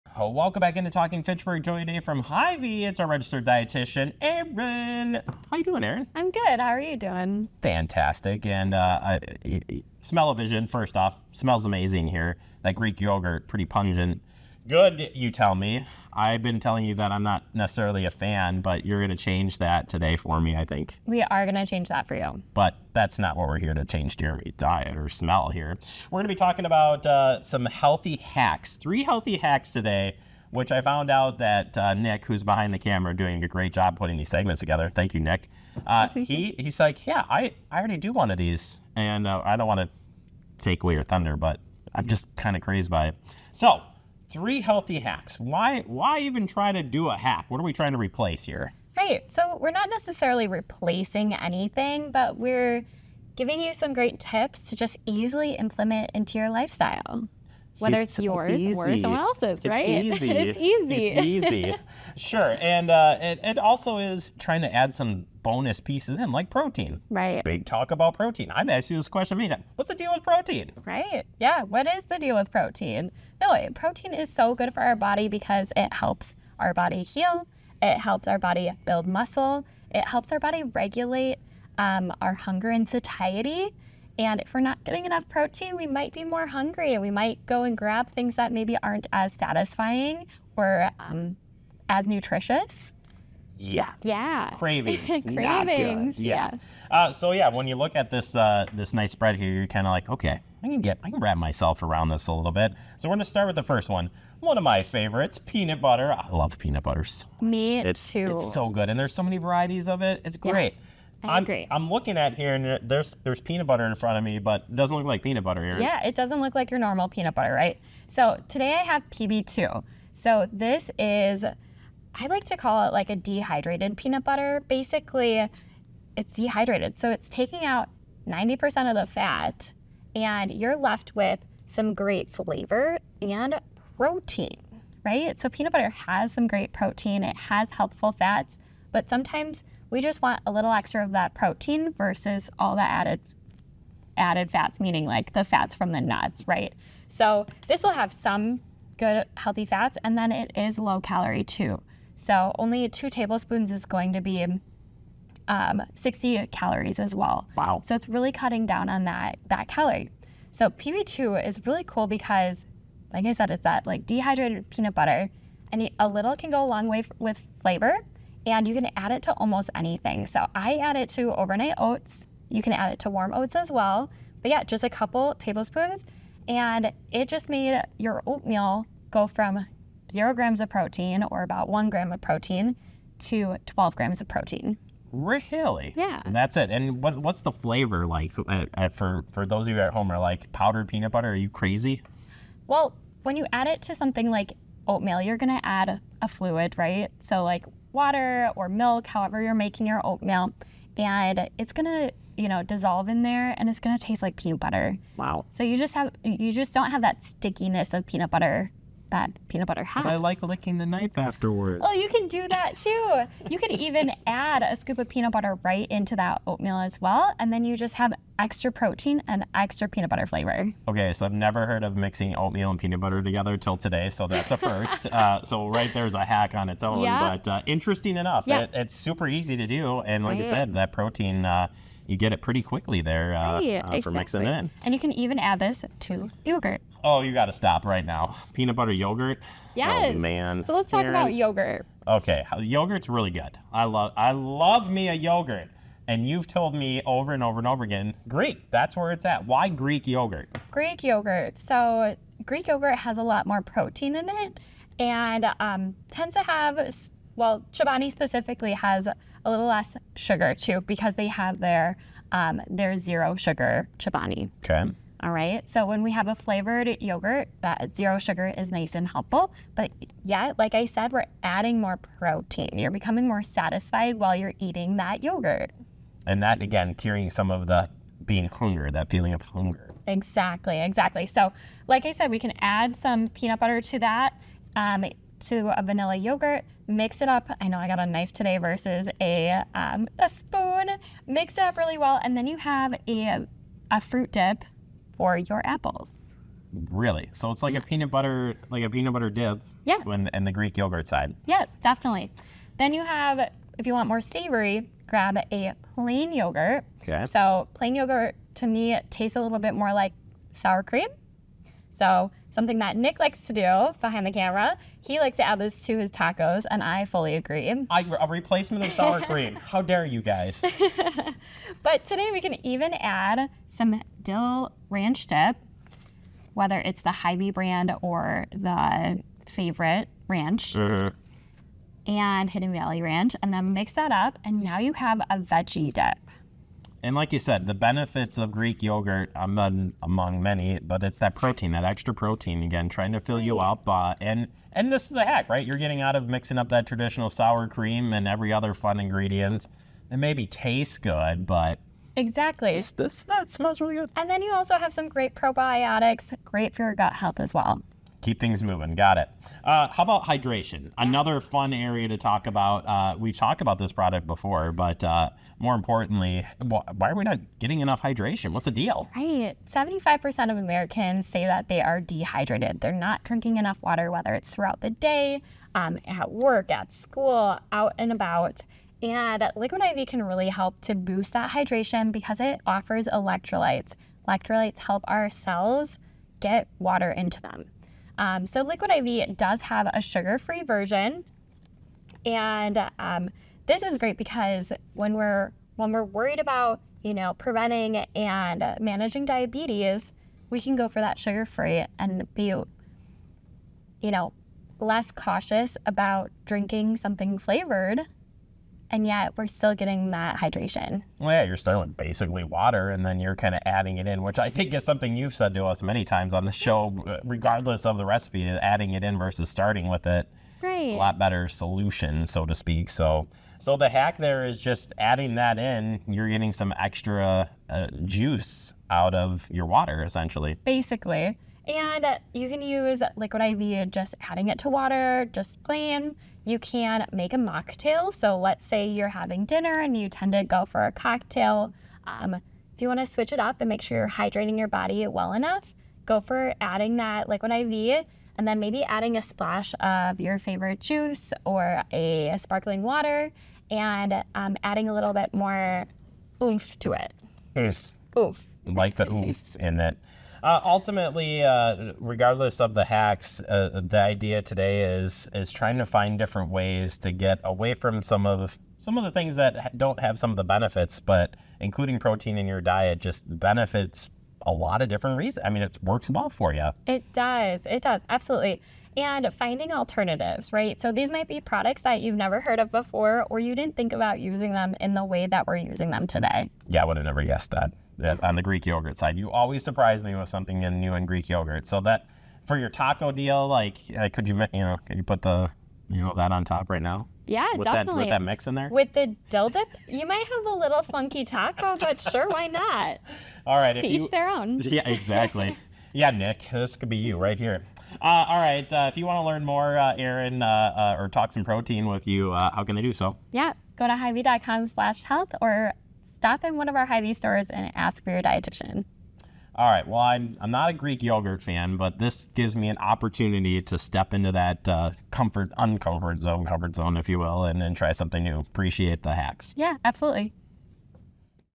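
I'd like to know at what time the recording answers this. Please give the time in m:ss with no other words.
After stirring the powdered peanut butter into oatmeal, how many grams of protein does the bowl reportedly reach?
3:03.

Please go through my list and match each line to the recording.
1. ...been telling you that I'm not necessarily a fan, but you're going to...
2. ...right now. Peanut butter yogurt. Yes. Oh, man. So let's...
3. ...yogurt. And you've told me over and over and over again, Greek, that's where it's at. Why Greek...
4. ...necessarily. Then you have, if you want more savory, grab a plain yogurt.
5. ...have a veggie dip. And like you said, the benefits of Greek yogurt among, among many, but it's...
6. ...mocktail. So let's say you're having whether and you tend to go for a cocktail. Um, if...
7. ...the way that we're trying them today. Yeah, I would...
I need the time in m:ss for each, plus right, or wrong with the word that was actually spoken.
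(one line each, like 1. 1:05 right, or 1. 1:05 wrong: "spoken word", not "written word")
1. 0:16 right
2. 3:57 right
3. 4:05 right
4. 5:01 wrong: "definitely", not "necessarily"
5. 5:34 right
6. 7:17 wrong: "dinner", not "whether"
7. 8:04 wrong: "using", not "trying".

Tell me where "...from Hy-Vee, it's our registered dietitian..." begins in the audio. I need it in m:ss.
0:01.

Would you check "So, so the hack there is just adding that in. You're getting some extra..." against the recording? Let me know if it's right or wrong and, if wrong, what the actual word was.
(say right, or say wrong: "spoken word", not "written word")
right.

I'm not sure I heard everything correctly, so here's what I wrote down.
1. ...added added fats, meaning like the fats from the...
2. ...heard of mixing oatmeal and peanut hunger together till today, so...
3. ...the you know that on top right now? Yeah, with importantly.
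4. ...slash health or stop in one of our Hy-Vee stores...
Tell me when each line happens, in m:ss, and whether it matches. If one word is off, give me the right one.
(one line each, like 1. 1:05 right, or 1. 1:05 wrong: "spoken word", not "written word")
1. 2:22 right
2. 3:41 wrong: "butter", not "hunger"
3. 8:15 wrong: "definitely", not "importantly"
4. 8:34 right.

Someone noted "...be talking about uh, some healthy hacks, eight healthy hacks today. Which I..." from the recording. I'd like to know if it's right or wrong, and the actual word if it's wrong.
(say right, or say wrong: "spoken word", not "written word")
wrong: "three", not "eight".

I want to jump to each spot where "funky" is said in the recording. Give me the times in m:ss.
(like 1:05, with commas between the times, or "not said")
8:20.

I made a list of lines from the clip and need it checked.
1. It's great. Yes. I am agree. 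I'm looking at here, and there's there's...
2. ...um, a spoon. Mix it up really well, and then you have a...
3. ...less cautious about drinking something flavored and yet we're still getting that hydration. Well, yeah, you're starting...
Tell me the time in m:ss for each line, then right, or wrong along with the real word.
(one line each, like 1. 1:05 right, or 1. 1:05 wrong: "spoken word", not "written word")
1. 1:50 right
2. 4:49 right
3. 6:44 right.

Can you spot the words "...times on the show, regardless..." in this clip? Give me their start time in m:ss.
6:56.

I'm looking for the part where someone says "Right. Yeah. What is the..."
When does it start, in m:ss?
1:10.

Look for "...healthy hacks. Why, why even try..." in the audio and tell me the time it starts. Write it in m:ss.
0:44.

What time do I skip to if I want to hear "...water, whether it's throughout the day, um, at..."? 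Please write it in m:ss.
6:13.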